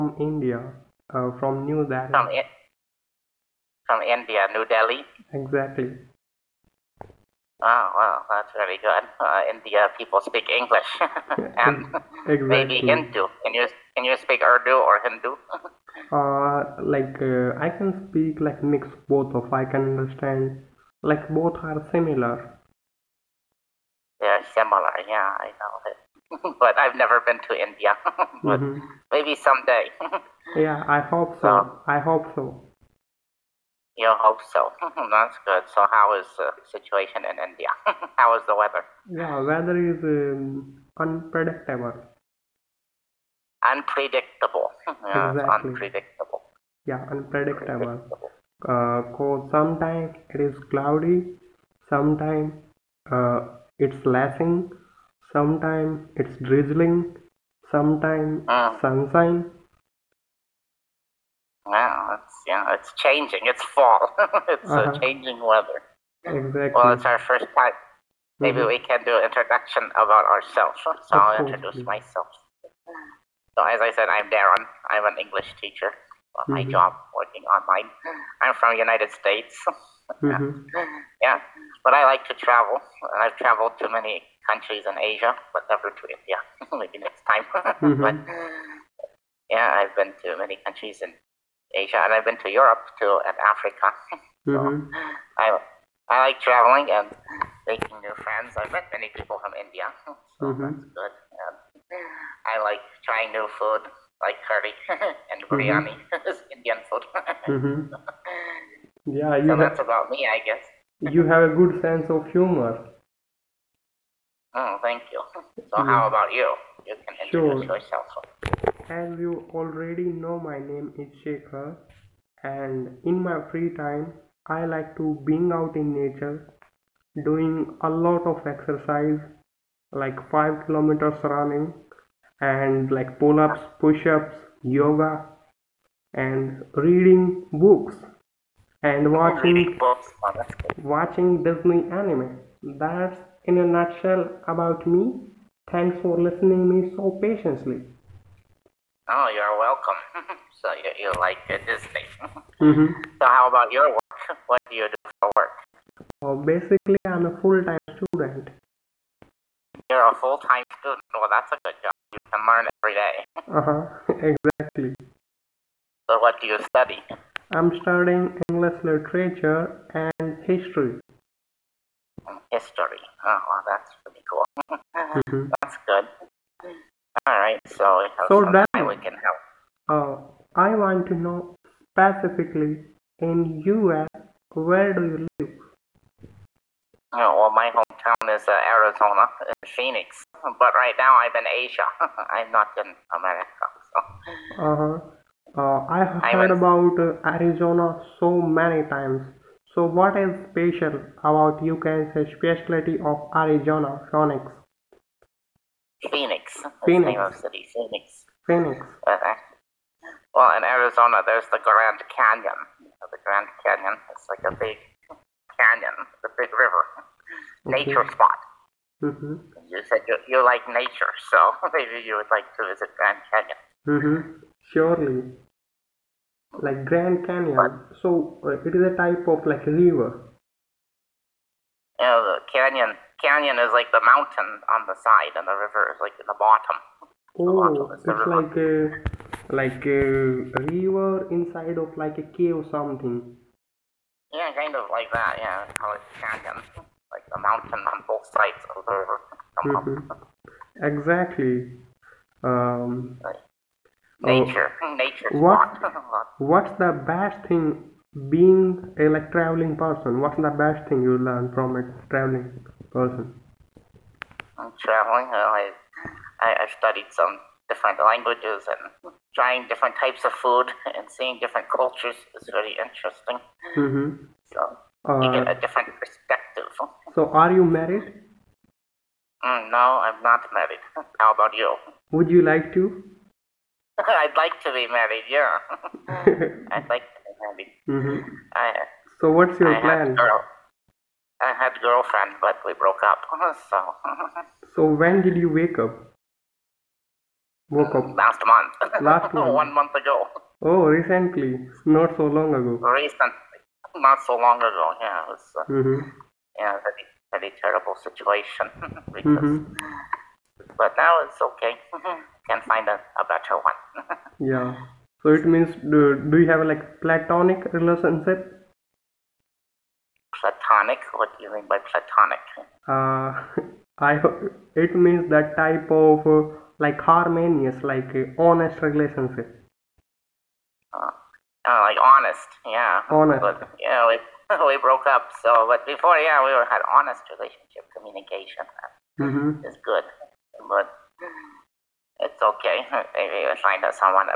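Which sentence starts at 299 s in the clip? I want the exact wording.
one month ago oh recently not so long ago recently not so long ago yeah it's uh, mm-hmm.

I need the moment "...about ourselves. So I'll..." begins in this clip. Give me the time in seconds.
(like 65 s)
70 s.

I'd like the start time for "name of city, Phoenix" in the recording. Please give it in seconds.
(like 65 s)
207 s.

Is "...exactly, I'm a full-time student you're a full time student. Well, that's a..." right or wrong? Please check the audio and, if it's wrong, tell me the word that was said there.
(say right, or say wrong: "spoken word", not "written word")
wrong: "basically", not "exactly".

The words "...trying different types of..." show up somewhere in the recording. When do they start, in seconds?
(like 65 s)
269 s.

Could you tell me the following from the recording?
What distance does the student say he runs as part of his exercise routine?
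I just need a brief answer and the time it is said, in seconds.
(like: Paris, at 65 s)
5 kilometers, at 130 s.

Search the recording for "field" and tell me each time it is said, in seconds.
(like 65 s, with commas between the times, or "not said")
not said.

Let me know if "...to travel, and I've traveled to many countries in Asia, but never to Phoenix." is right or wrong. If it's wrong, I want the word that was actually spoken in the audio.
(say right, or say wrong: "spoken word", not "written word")
wrong: "India", not "Phoenix".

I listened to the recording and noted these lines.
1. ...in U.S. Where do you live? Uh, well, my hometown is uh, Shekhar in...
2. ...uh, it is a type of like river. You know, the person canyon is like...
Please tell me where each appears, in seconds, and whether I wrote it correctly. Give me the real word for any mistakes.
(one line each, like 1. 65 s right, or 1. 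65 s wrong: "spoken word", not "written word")
1. 183 s wrong: "Arizona", not "Shekhar"
2. 228 s wrong: "canyon", not "person".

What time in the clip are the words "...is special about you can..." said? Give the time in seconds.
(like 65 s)
200 s.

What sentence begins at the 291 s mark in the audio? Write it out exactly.
I had a girlfriend, but we broke up.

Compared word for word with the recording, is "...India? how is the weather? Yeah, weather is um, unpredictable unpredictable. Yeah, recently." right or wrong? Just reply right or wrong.
wrong.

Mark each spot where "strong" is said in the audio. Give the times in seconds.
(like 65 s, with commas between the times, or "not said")
not said.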